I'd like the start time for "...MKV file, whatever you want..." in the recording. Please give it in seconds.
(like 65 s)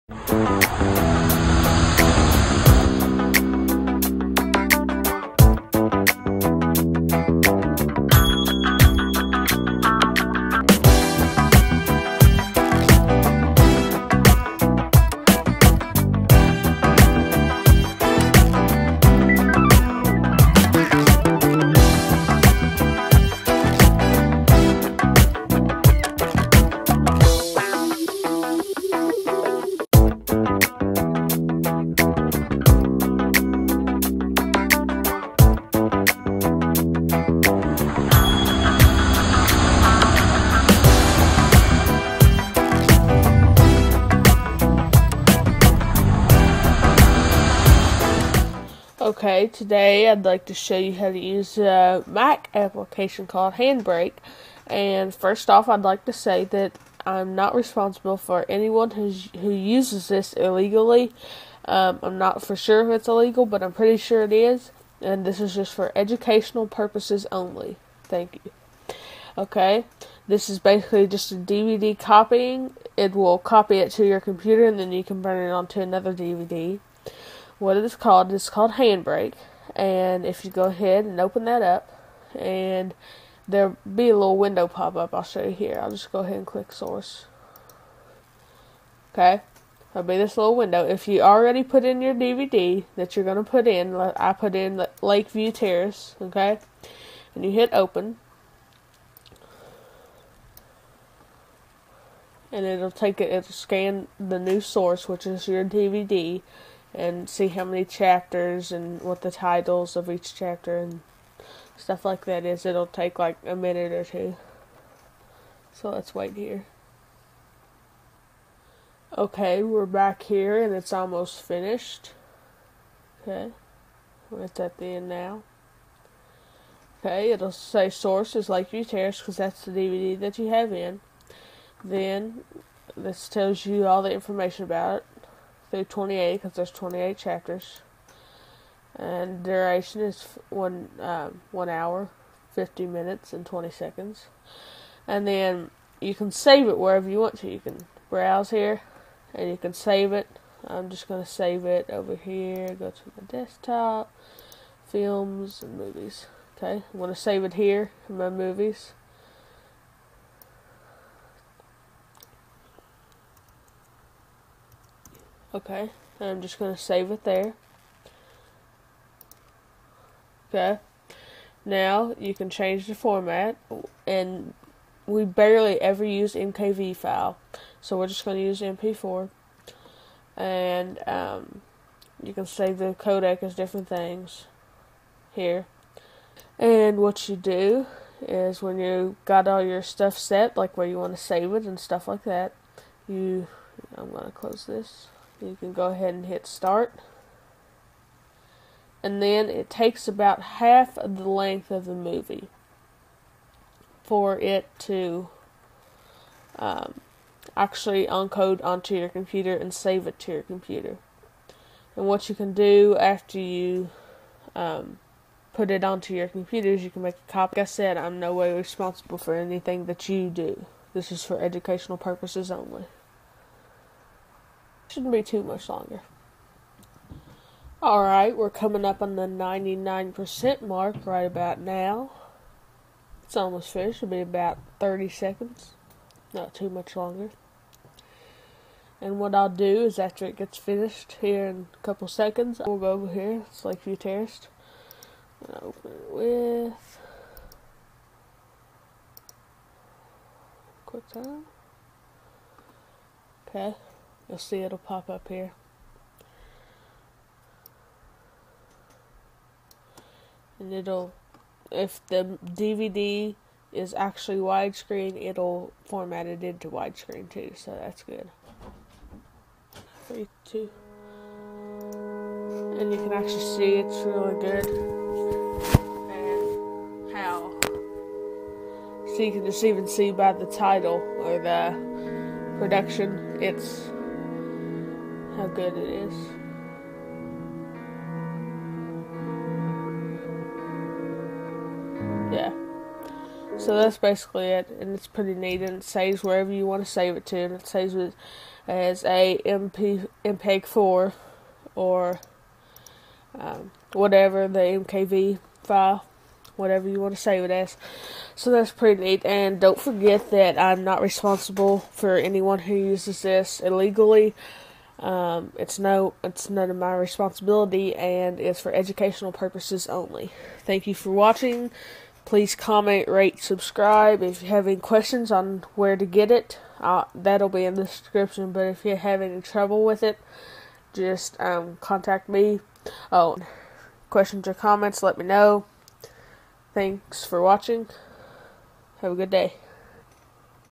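304 s.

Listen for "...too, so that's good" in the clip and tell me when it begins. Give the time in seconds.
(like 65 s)
267 s.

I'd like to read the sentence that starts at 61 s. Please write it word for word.
Um, I'm not for sure if it's illegal, but I'm pretty sure it is.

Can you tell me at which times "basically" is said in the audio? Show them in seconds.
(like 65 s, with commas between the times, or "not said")
70 s, 293 s.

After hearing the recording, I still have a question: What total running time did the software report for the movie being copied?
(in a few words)
1 hour, 50 minutes and 20 seconds.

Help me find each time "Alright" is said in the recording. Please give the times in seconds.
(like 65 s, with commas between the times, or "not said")
227 s.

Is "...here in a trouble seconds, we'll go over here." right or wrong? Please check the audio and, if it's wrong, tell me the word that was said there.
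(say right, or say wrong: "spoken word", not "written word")
wrong: "couple", not "trouble".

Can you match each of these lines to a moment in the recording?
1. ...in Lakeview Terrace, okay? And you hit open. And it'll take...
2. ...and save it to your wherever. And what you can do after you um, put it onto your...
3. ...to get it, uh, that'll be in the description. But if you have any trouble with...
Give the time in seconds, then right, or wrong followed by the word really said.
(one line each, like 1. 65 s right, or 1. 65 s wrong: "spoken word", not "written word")
1. 94 s right
2. 209 s wrong: "computer", not "wherever"
3. 325 s right.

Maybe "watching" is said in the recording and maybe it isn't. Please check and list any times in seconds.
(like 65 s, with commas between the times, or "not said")
321 s, 337 s.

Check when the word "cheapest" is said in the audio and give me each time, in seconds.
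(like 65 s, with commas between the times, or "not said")
not said.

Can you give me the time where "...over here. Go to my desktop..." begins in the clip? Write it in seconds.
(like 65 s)
151 s.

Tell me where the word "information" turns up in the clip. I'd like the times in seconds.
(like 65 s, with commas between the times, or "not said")
134 s.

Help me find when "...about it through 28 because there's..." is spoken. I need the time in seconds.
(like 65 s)
134 s.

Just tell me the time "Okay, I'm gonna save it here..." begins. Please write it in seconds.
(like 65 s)
156 s.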